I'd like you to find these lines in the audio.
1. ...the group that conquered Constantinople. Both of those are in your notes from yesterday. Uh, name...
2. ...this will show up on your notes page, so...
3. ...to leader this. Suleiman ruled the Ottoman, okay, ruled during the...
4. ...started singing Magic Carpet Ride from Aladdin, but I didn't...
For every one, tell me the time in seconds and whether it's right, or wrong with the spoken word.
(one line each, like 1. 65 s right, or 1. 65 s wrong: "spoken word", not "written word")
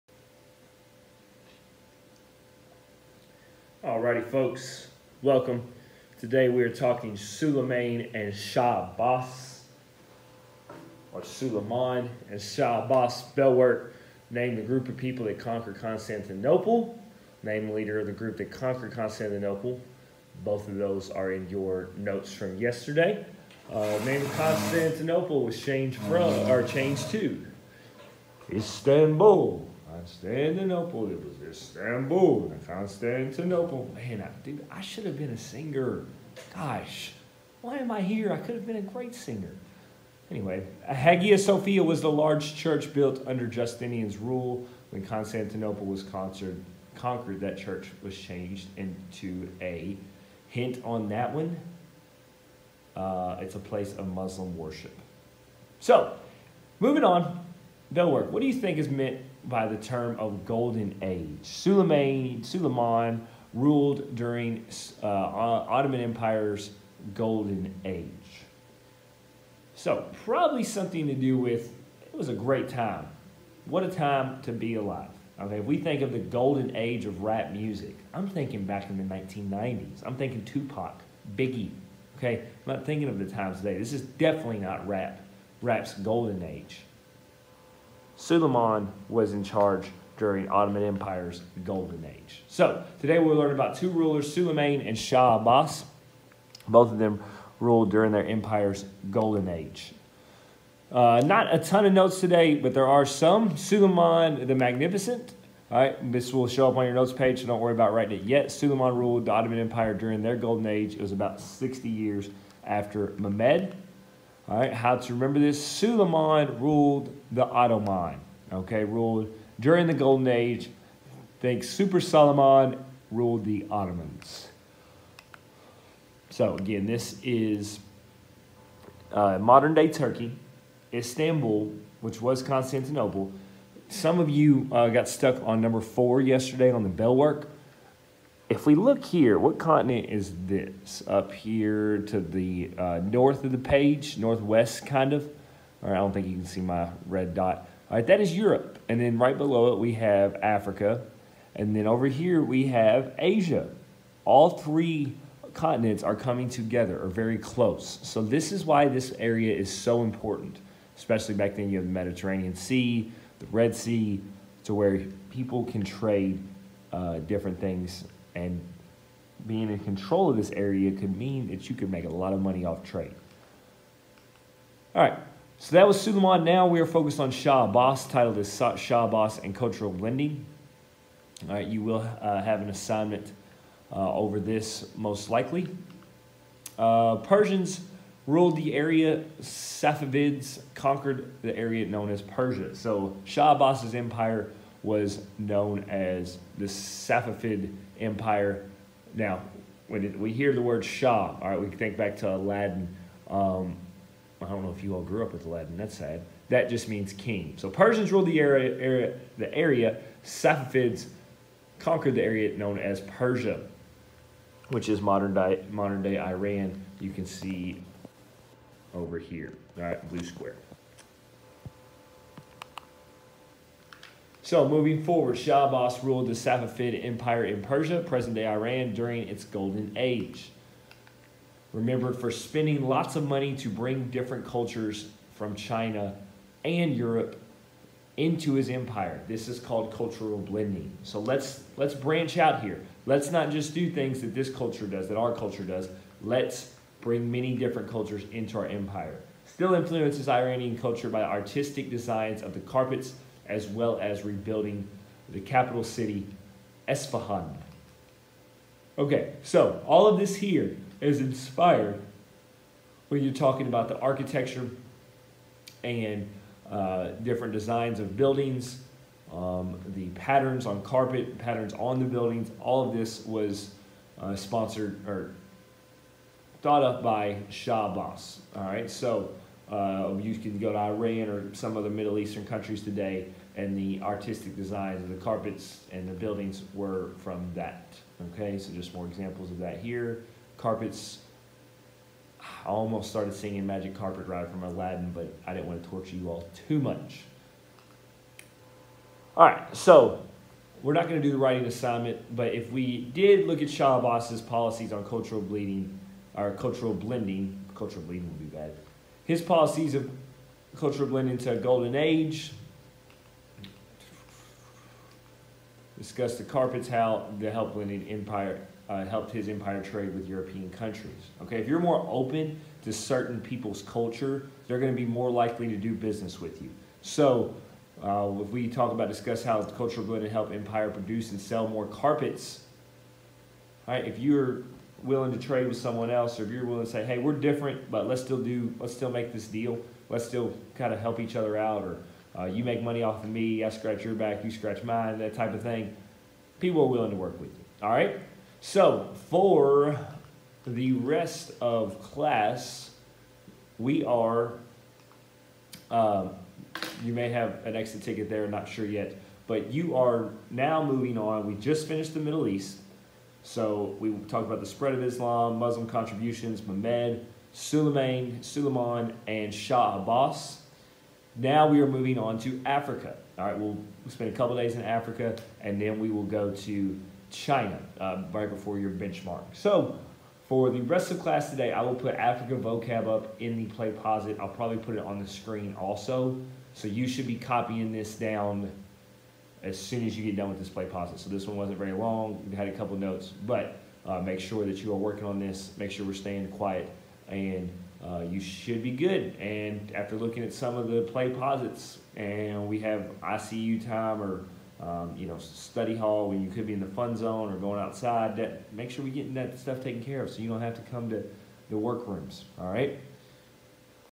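1. 18 s right
2. 106 s right
3. 114 s wrong: "remember", not "leader"
4. 293 s right.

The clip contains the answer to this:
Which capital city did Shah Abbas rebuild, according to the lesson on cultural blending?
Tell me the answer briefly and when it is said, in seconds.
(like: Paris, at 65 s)
Esfahan, at 256 s.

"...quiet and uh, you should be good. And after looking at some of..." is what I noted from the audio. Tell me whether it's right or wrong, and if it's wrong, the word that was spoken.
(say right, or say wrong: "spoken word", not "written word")
right.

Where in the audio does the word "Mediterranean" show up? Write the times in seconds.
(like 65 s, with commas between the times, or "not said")
161 s.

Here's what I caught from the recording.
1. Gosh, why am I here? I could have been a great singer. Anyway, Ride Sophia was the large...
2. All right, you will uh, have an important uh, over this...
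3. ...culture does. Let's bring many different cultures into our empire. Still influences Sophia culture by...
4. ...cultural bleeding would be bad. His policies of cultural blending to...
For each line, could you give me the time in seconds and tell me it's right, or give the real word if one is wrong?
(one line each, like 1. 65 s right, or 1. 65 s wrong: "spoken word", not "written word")
1. 36 s wrong: "Hagia", not "Ride"
2. 181 s wrong: "assignment", not "important"
3. 245 s wrong: "Iranian", not "Sophia"
4. 307 s right.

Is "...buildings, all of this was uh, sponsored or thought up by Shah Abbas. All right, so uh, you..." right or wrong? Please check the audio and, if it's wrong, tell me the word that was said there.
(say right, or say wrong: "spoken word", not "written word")
right.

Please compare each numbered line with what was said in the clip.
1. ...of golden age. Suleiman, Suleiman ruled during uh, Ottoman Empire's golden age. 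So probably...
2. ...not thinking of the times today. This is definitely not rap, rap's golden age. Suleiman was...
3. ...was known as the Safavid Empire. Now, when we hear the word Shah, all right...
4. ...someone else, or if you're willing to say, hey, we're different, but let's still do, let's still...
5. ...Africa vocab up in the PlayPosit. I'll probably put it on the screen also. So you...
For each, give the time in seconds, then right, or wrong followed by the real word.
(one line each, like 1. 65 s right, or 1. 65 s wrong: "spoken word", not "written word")
1. 60 s right
2. 82 s right
3. 194 s right
4. 335 s right
5. 382 s right.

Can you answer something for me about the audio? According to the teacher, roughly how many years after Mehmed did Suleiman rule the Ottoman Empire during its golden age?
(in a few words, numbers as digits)
60 years.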